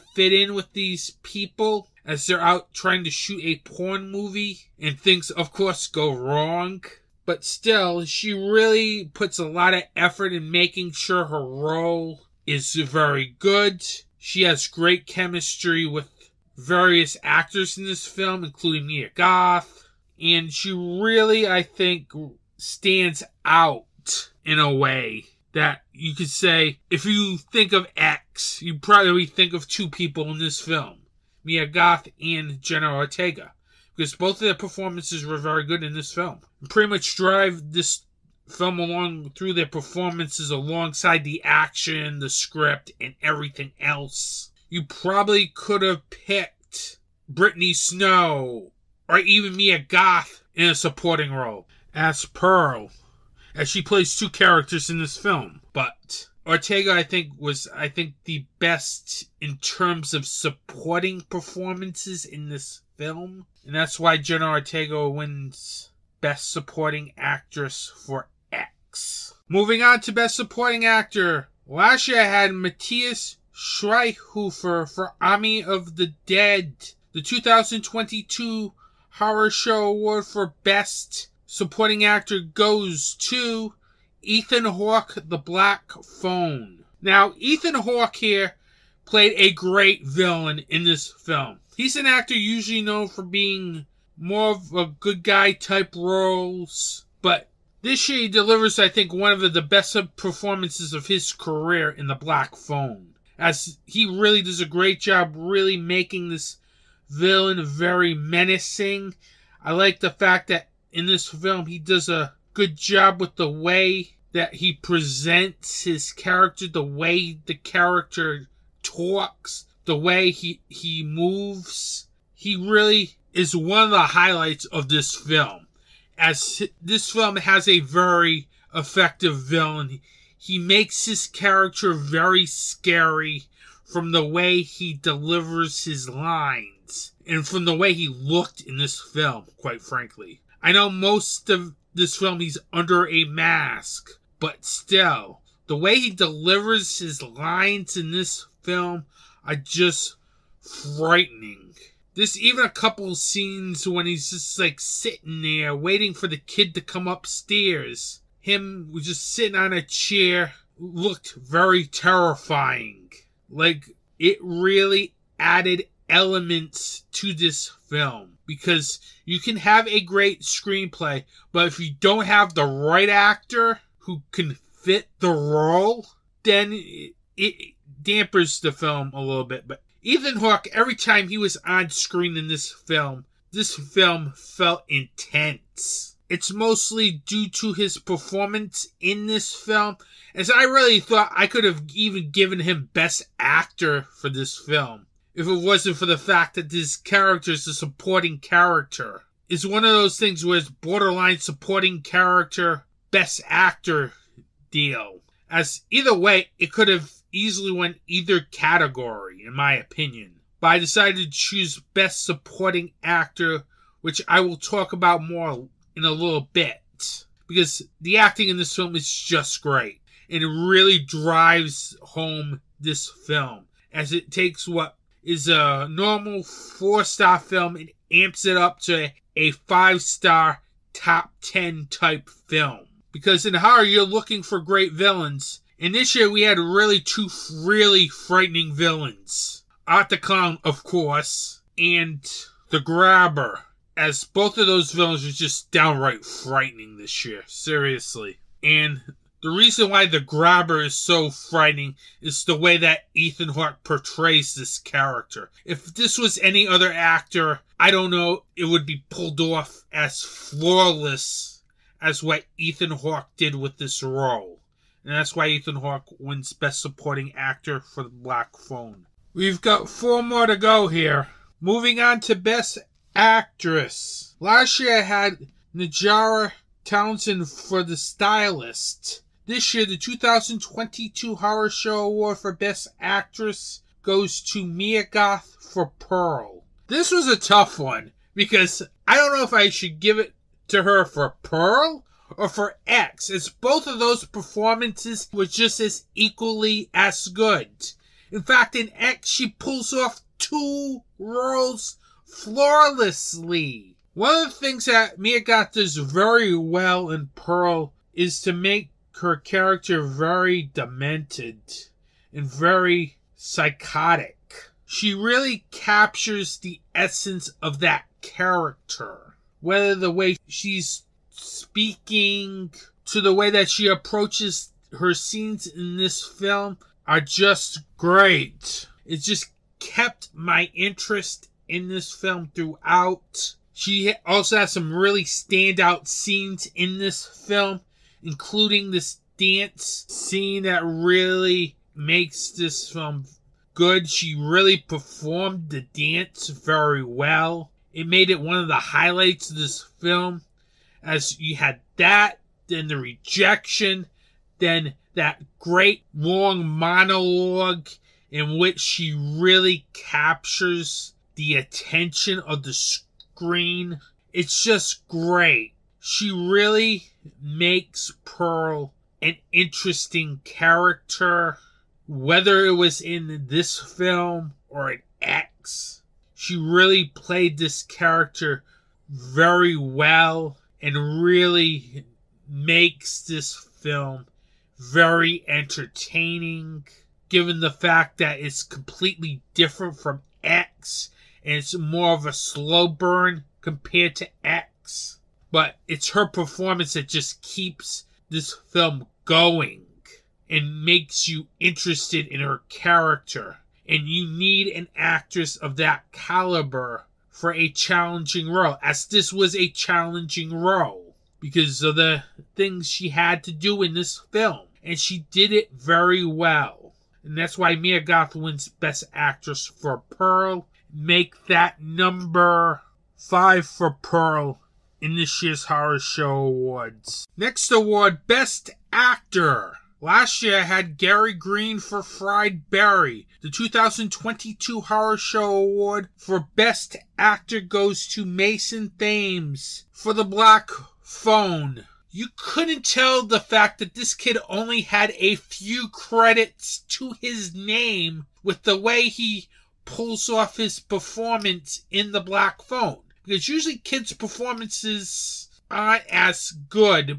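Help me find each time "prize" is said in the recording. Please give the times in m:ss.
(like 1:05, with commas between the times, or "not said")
not said.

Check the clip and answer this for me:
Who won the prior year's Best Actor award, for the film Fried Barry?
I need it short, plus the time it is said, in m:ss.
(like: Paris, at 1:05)
Gary Green, at 7:10.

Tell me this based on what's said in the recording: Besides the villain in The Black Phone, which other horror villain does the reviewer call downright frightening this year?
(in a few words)
Art the Clown.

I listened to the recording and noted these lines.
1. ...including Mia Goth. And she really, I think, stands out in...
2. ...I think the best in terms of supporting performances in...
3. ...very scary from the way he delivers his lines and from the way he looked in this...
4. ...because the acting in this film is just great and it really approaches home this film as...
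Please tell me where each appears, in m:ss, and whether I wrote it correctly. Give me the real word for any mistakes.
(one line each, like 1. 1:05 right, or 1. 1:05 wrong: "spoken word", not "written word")
1. 0:18 right
2. 0:57 right
3. 2:11 right
4. 3:37 wrong: "drives", not "approaches".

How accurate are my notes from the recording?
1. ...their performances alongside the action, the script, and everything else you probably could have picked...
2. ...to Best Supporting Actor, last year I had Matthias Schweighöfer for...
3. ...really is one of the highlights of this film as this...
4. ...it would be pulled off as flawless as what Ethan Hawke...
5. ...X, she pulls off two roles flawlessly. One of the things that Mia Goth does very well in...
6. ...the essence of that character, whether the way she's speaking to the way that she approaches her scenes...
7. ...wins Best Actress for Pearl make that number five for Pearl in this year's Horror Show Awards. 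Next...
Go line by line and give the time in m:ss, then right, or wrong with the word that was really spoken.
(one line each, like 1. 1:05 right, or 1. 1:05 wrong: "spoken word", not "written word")
1. 0:39 right
2. 1:09 right
3. 2:02 right
4. 4:18 right
5. 4:58 right
6. 5:16 right
7. 6:58 right.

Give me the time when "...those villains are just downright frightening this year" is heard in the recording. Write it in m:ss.
4:04.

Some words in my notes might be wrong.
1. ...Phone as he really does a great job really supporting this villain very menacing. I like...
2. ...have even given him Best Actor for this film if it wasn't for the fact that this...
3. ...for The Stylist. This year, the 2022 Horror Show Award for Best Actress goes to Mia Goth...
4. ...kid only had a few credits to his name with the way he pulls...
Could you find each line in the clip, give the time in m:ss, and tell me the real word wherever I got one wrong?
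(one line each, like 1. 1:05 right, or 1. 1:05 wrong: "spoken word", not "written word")
1. 1:42 wrong: "making", not "supporting"
2. 3:11 right
3. 4:37 right
4. 7:24 right.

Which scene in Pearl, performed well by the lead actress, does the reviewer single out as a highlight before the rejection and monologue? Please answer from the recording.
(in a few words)
dance scene.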